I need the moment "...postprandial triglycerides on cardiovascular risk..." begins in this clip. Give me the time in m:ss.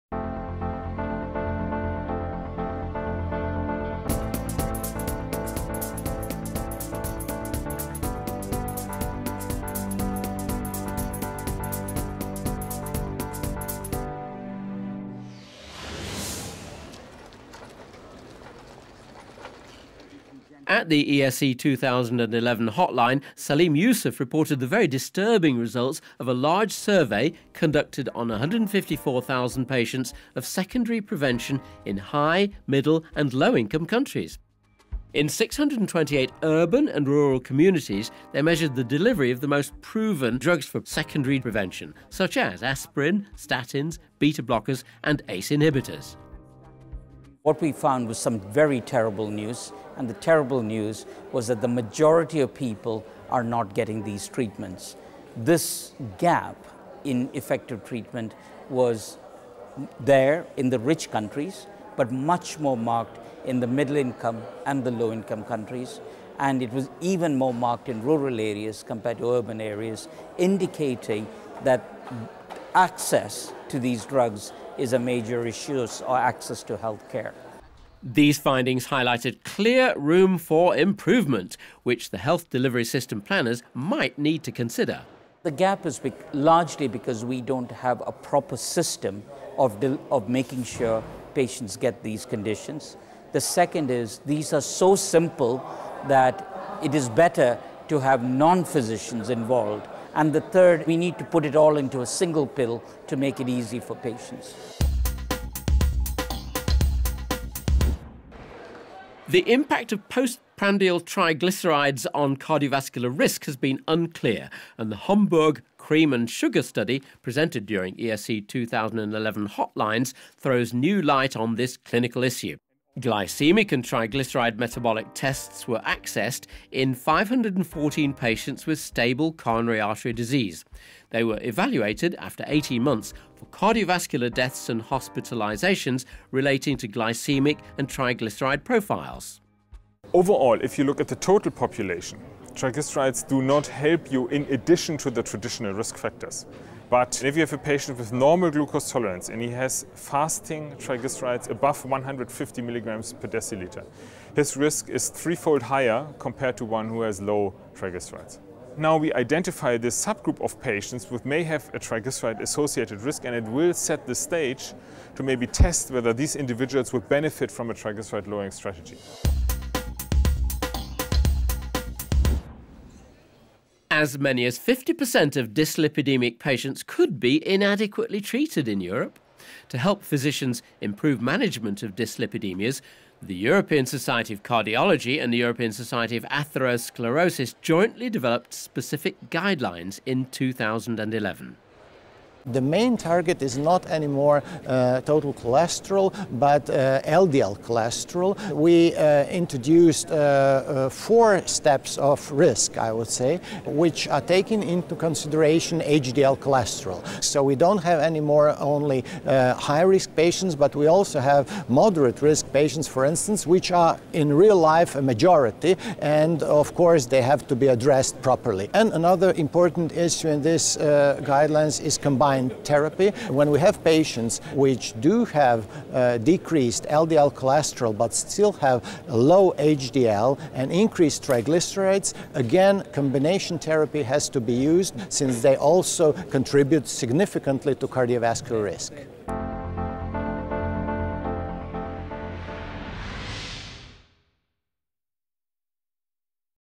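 1:50.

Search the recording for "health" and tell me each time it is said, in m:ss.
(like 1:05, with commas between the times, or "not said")
1:16, 1:22.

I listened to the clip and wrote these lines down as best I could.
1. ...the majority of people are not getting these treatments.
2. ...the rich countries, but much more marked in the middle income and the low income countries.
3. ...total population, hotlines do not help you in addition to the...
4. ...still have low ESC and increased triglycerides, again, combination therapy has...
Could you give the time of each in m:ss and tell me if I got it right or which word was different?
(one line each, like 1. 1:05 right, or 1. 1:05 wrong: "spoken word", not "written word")
1. 0:51 right
2. 1:00 right
3. 2:21 wrong: "triglycerides", not "hotlines"
4. 3:48 wrong: "HDL", not "ESC".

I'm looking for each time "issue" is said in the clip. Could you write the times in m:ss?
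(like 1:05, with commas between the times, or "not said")
1:15, 2:02, 3:39.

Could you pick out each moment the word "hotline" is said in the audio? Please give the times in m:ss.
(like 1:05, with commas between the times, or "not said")
0:22, 1:59.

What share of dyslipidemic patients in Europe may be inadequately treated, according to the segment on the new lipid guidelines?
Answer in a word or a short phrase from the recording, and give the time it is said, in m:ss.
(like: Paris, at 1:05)
50%, at 2:54.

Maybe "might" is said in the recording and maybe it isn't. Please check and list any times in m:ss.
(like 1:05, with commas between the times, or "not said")
1:23.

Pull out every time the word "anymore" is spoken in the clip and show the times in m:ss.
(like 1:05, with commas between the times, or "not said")
3:13, 3:27.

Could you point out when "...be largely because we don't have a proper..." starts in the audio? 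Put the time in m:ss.
1:25.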